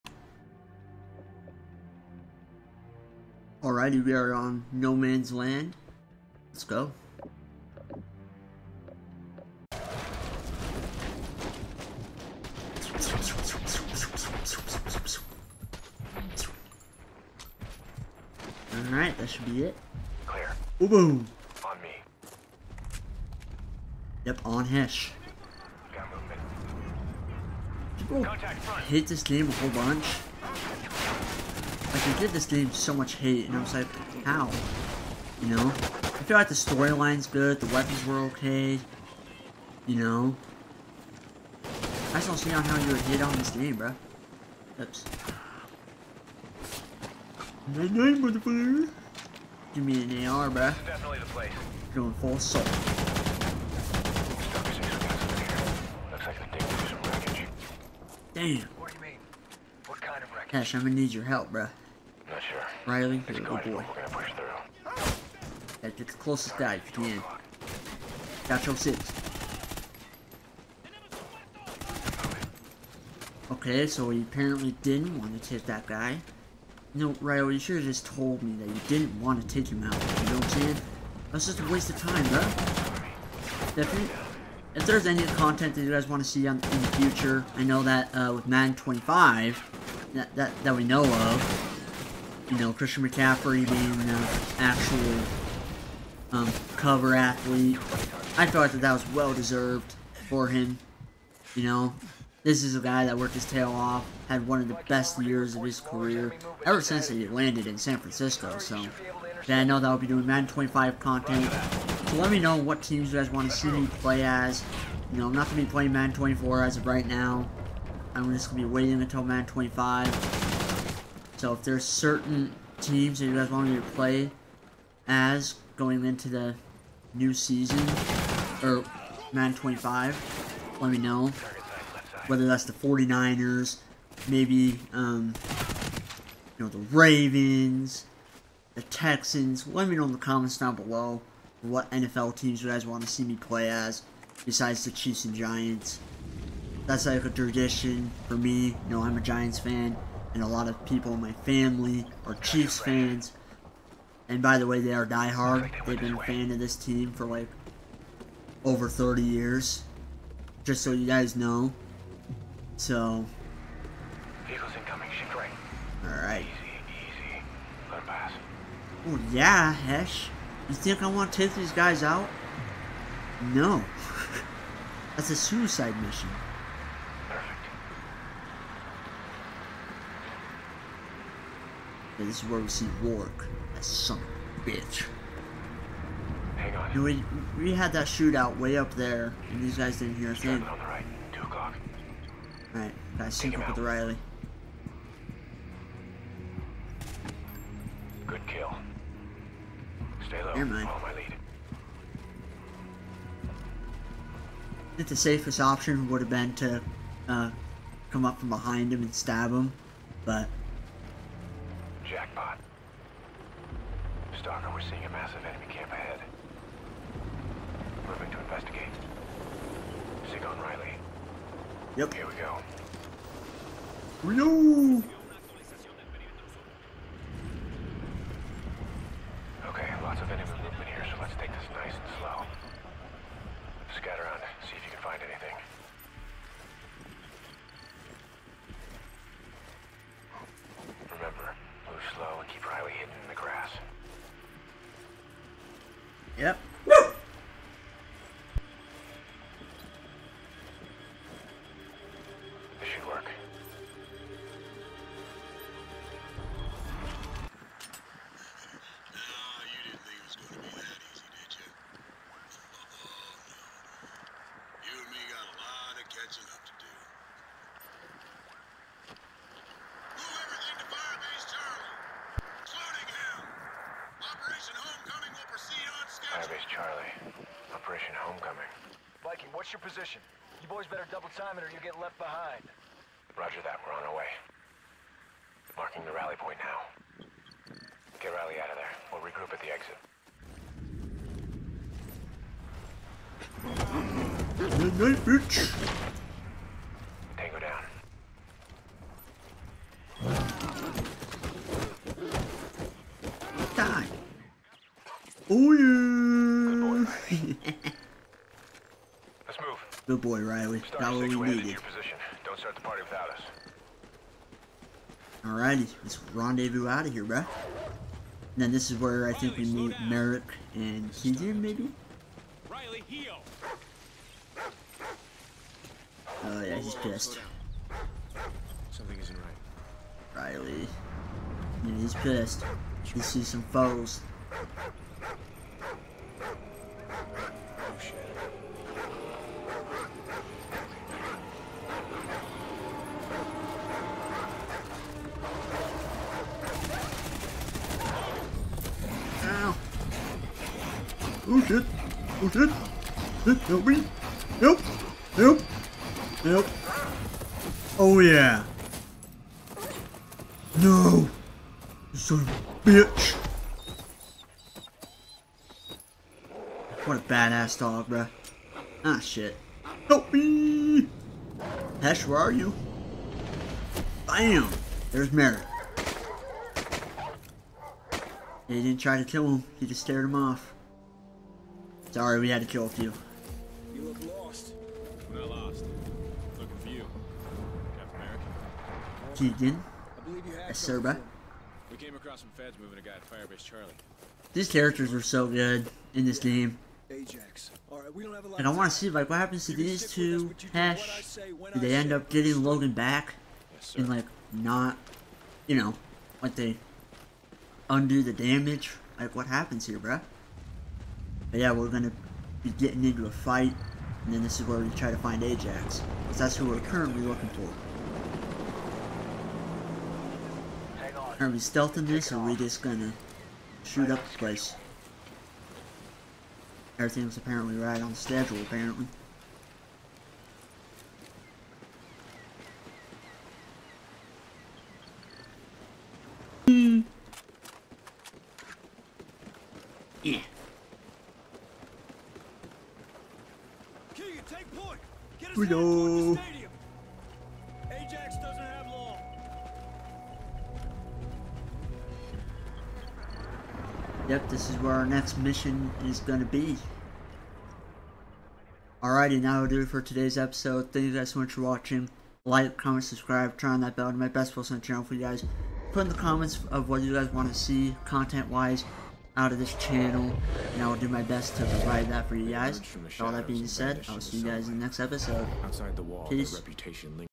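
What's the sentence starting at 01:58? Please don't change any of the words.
I'm just gonna be waiting until Madden 25.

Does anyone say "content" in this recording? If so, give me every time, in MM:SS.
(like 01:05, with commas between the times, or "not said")
01:25, 01:50, 07:48.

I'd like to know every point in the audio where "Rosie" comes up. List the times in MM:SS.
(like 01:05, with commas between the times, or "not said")
03:02.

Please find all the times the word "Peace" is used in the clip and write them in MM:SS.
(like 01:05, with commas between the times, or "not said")
07:56.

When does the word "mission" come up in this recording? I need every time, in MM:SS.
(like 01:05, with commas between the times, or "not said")
02:56, 07:35.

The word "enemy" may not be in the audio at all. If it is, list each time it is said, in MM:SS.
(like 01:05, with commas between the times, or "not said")
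03:35.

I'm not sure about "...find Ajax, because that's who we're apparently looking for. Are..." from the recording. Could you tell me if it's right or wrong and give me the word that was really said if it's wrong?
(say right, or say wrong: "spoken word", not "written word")
wrong: "currently", not "apparently".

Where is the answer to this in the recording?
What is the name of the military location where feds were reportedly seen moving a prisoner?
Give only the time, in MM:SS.
06:33.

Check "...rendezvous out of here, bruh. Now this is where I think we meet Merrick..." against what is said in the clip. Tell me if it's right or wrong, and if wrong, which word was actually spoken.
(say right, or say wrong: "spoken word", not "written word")
right.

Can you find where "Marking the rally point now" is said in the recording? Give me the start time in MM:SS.
04:45.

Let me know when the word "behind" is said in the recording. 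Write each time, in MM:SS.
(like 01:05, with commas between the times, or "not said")
03:28, 04:42.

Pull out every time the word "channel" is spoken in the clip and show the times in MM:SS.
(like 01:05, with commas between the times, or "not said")
07:44, 07:49.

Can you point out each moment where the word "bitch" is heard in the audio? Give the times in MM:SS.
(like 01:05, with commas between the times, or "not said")
03:04, 04:55, 06:02.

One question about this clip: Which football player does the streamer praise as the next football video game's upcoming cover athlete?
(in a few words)
Christian McCaffrey.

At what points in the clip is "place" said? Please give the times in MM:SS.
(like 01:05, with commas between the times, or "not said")
00:51, 07:04.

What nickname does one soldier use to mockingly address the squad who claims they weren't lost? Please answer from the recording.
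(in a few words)
Captain America.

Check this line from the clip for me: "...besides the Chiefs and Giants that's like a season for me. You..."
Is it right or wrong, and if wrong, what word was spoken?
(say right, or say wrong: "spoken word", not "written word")
wrong: "tradition", not "season".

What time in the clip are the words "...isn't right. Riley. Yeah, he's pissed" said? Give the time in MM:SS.
05:29.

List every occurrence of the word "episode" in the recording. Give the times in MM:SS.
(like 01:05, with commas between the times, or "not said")
07:40, 07:54.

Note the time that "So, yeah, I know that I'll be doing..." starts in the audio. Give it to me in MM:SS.
01:48.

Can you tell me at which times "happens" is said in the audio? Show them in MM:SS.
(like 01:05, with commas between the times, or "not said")
06:39, 06:49.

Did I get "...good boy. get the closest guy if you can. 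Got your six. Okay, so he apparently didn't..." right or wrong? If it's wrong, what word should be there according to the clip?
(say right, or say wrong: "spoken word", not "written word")
right.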